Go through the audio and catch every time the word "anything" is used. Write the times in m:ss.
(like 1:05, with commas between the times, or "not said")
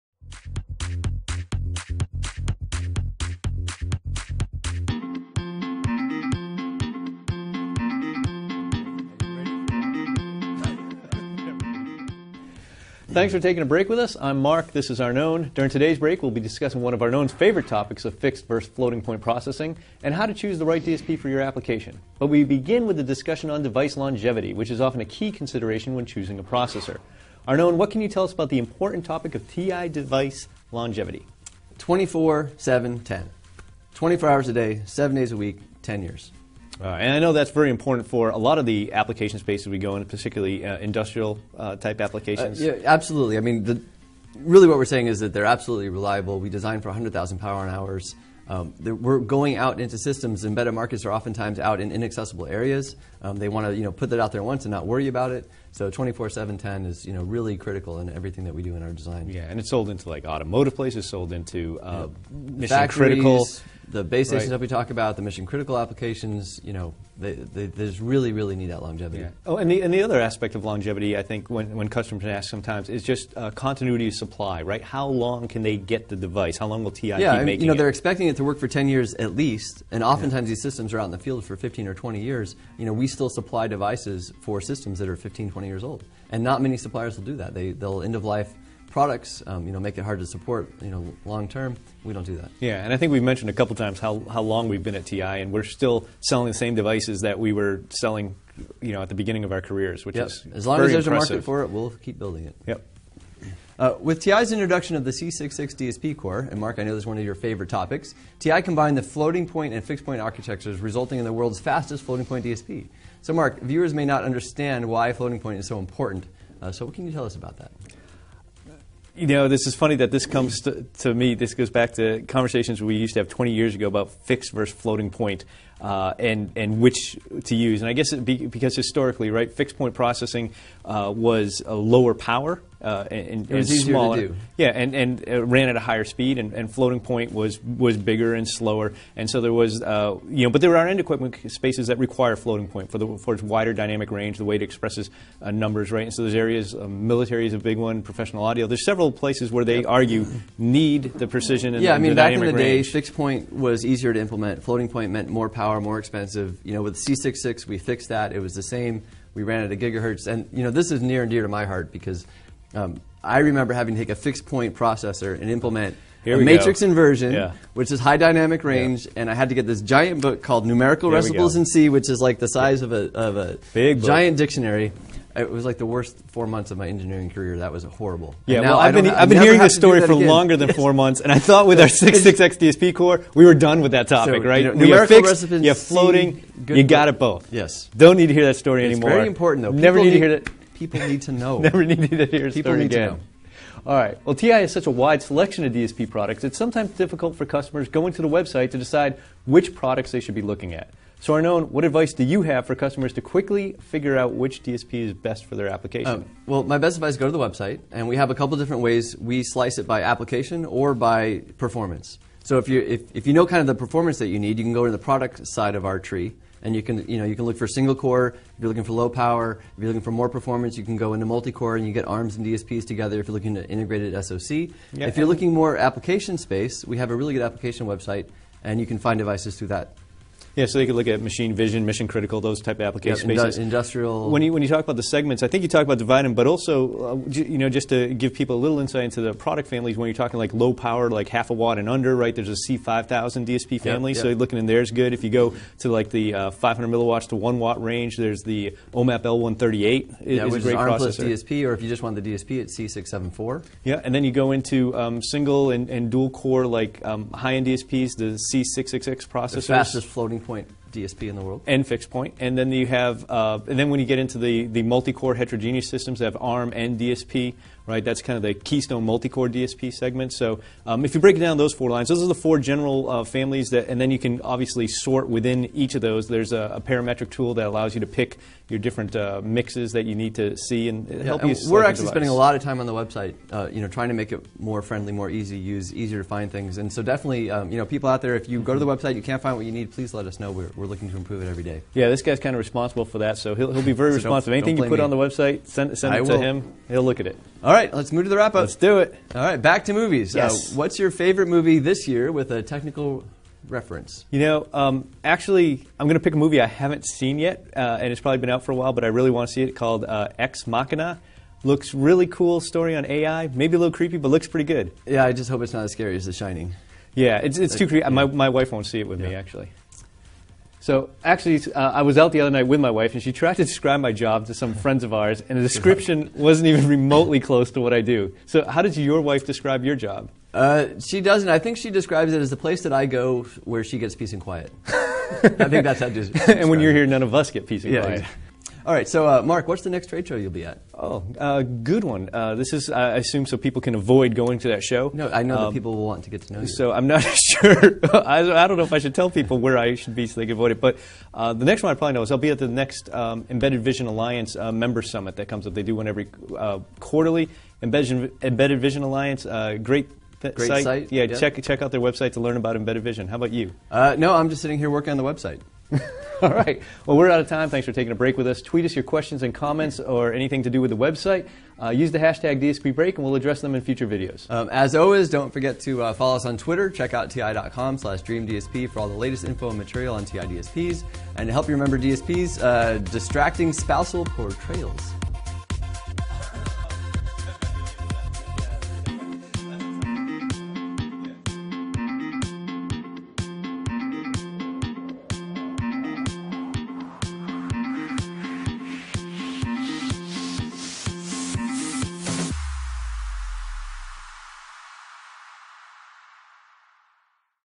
4:54, 6:10.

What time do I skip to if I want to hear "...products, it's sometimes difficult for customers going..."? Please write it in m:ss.
3:16.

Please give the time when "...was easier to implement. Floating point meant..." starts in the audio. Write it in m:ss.
2:33.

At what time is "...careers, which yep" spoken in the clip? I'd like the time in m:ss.
1:39.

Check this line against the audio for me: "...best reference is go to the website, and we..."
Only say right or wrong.
wrong.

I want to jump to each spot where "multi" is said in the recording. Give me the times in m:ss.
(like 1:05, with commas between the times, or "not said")
3:41, 4:24, 4:29.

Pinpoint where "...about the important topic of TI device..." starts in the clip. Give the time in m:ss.
0:28.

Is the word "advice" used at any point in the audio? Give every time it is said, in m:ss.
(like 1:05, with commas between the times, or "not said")
3:21, 3:26.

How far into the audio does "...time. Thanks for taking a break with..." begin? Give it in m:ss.
6:07.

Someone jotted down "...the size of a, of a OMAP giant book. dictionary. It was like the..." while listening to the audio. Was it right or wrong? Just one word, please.
wrong.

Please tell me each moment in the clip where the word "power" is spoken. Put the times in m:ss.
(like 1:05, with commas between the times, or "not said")
0:47, 2:12, 2:35, 3:39, 4:00.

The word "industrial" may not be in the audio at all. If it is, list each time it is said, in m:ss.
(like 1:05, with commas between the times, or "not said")
0:40, 3:53.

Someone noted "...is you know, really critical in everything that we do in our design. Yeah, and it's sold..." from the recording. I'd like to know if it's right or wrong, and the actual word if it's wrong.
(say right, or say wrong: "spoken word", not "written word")
right.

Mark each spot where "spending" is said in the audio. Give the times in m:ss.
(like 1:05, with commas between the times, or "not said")
4:42.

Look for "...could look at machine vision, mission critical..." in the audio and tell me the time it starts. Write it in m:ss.
3:50.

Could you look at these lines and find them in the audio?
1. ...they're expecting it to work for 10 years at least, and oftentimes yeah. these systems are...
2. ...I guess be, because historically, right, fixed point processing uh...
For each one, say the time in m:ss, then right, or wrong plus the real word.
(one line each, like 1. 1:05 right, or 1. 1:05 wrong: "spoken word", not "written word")
1. 1:17 right
2. 2:07 right.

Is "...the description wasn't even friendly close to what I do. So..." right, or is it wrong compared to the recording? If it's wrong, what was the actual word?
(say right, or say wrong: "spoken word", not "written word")
wrong: "remotely", not "friendly".